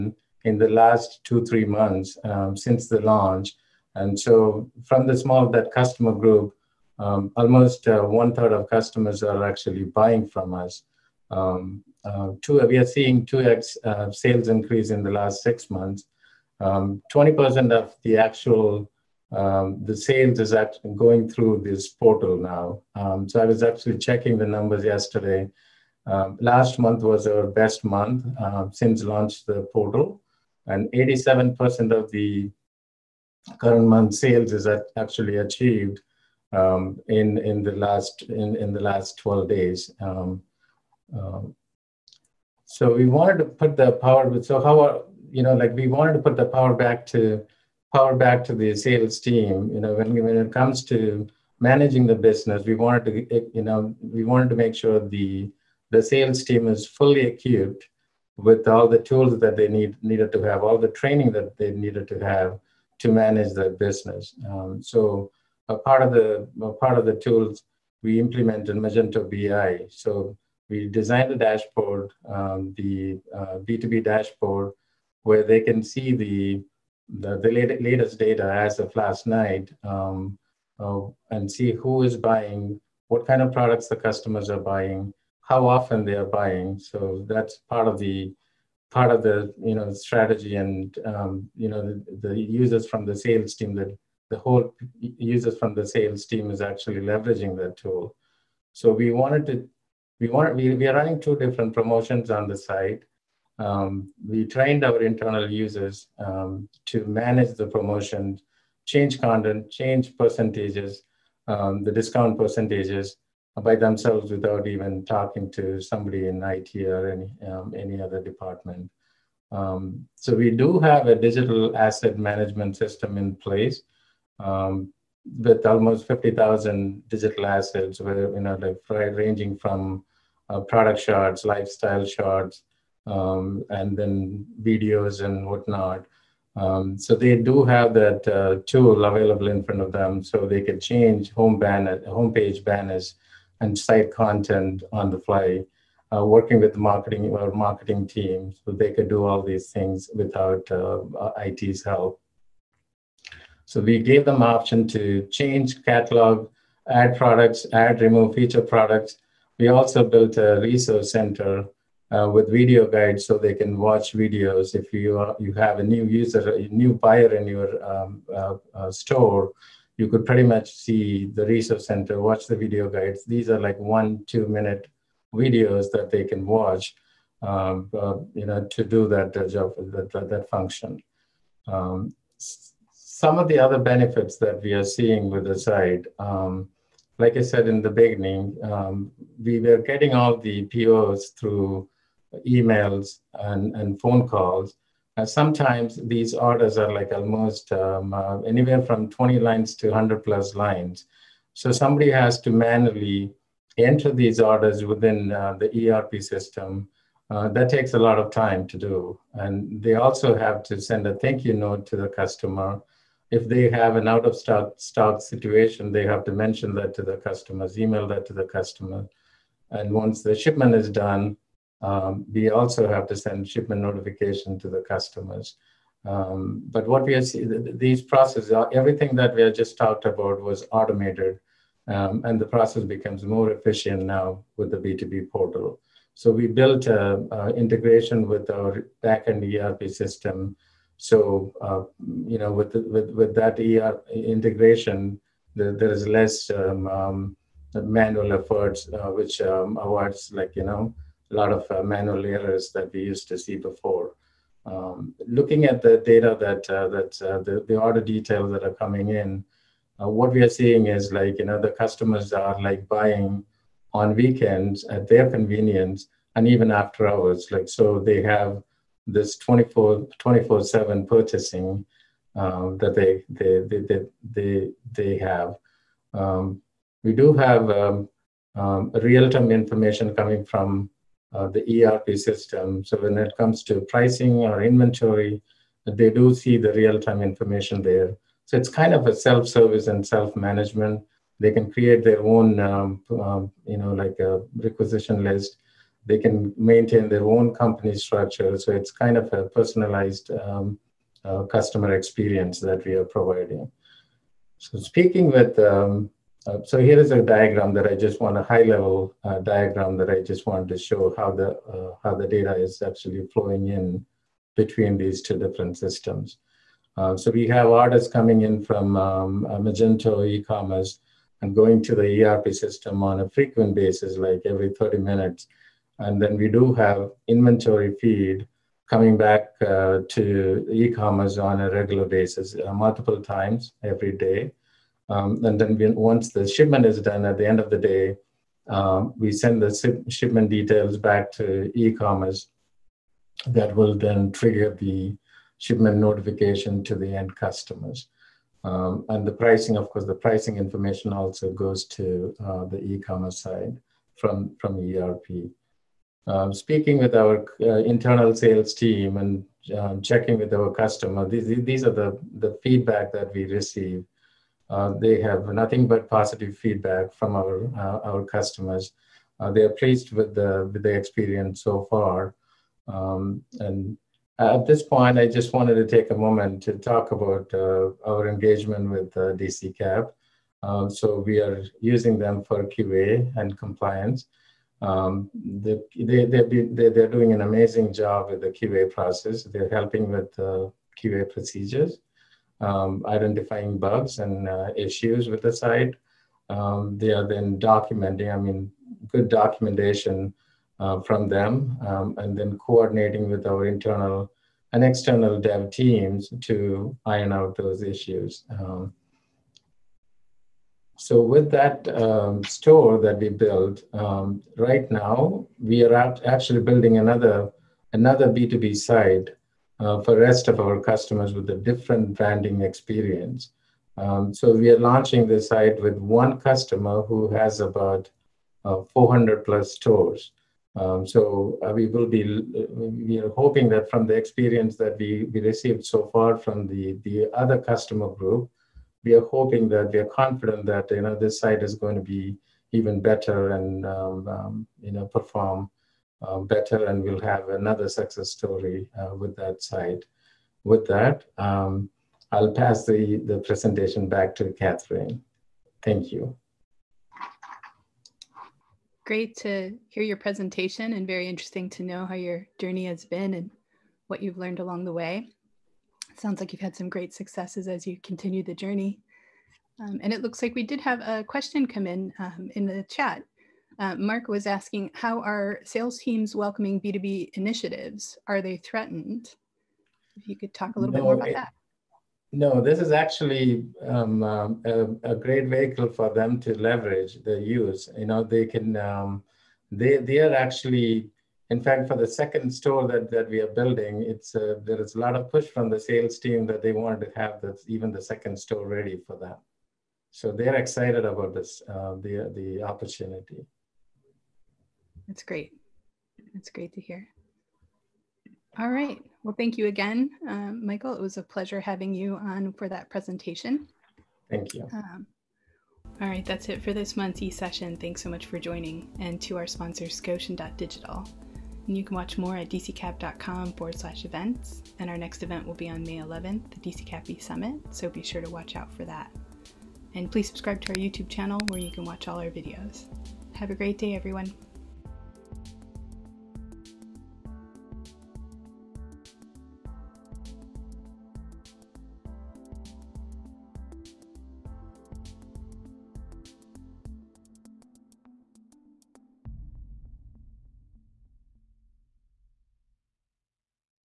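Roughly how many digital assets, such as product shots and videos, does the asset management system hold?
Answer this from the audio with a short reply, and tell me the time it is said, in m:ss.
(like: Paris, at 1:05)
50,000, at 2:06.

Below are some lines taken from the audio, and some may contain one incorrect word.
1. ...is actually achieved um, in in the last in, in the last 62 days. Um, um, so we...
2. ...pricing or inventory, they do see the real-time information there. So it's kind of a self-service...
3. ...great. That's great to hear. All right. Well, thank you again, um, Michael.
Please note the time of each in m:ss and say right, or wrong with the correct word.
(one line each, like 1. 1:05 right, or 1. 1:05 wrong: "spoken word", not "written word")
1. 0:34 wrong: "12", not "62"
2. 4:43 right
3. 8:25 right.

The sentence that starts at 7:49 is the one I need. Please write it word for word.
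Um, and it looks like we did have a question come in um, in the chat.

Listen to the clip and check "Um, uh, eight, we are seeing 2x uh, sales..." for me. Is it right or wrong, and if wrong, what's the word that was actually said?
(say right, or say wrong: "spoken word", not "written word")
wrong: "two", not "eight".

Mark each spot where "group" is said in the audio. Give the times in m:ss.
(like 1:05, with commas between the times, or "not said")
0:06, 7:18.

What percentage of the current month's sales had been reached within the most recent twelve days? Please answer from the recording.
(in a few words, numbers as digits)
87%.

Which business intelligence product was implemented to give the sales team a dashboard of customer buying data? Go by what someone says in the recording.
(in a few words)
Magento BI.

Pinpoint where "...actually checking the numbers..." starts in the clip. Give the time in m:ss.
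0:23.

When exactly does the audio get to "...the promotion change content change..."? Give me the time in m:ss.
1:47.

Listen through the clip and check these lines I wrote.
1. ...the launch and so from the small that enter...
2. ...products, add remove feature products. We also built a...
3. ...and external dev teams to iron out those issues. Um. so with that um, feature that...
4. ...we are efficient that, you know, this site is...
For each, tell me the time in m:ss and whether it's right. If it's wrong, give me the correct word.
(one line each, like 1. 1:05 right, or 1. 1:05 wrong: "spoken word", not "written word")
1. 0:02 wrong: "customer", not "enter"
2. 2:37 right
3. 6:44 wrong: "store", not "feature"
4. 7:19 wrong: "confident", not "efficient".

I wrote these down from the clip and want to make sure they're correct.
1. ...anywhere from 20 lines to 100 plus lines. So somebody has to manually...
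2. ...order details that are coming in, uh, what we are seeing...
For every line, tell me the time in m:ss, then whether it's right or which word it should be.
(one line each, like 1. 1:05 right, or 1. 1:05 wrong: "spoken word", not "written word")
1. 3:18 right
2. 4:17 right.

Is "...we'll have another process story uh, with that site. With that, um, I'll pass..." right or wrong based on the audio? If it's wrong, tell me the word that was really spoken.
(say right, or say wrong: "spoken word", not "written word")
wrong: "success", not "process".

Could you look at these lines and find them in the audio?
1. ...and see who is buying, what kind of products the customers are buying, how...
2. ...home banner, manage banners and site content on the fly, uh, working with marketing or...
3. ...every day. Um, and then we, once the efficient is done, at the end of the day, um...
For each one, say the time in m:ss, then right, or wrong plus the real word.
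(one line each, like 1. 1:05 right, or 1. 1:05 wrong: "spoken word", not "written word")
1. 1:21 right
2. 2:21 wrong: "homepage", not "manage"
3. 5:33 wrong: "shipment", not "efficient".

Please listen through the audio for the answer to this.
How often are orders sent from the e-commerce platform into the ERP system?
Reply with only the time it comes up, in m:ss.
5:24.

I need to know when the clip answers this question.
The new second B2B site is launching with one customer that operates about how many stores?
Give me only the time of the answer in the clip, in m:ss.
7:08.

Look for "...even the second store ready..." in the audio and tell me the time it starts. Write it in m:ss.
8:17.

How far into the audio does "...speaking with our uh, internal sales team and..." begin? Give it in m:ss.
5:56.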